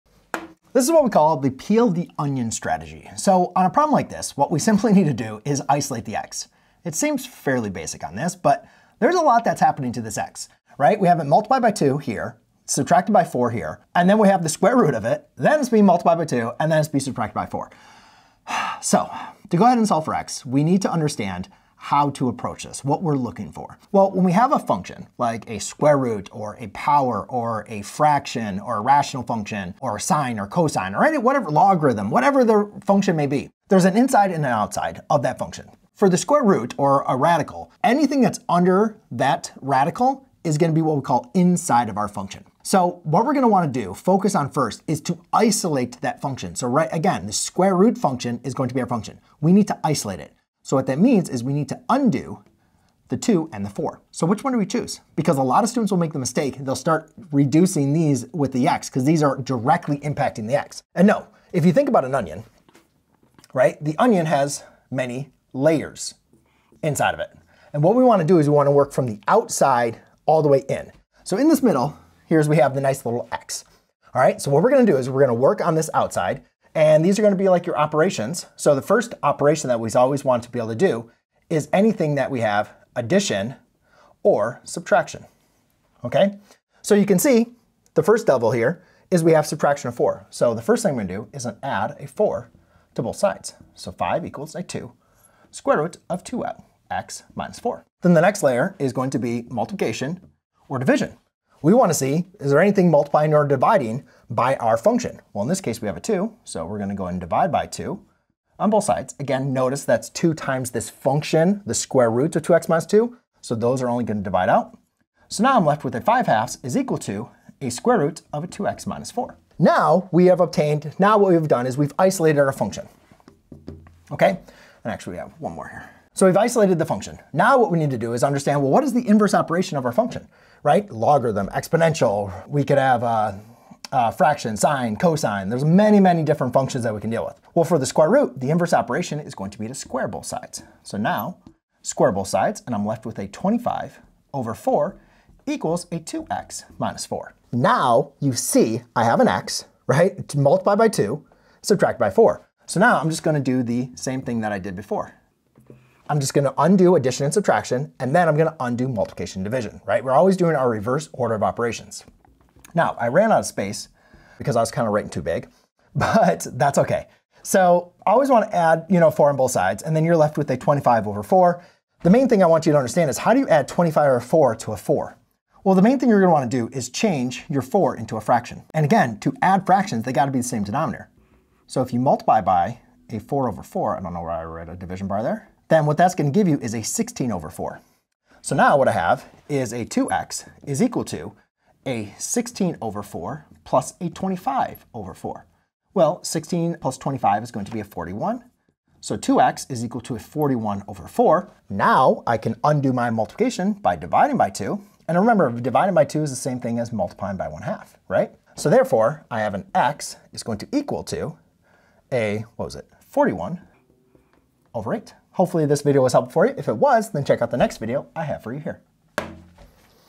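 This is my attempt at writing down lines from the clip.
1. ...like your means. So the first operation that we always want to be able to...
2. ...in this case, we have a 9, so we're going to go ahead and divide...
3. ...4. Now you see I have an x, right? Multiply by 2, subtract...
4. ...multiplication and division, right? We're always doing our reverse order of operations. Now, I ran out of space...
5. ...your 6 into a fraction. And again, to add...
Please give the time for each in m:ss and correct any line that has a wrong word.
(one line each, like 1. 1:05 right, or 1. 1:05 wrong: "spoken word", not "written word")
1. 1:17 wrong: "operations", not "means"
2. 1:45 wrong: "2", not "9"
3. 2:27 right
4. 2:38 right
5. 2:57 wrong: "4", not "6".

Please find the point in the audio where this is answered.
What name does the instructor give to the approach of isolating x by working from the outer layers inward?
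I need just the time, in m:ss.
0:01.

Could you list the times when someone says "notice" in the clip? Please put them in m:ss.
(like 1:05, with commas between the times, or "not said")
1:49.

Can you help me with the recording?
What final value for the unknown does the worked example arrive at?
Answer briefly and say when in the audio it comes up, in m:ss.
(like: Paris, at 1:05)
41/8, at 3:33.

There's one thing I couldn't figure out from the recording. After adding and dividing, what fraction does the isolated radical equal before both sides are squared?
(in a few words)
5/2.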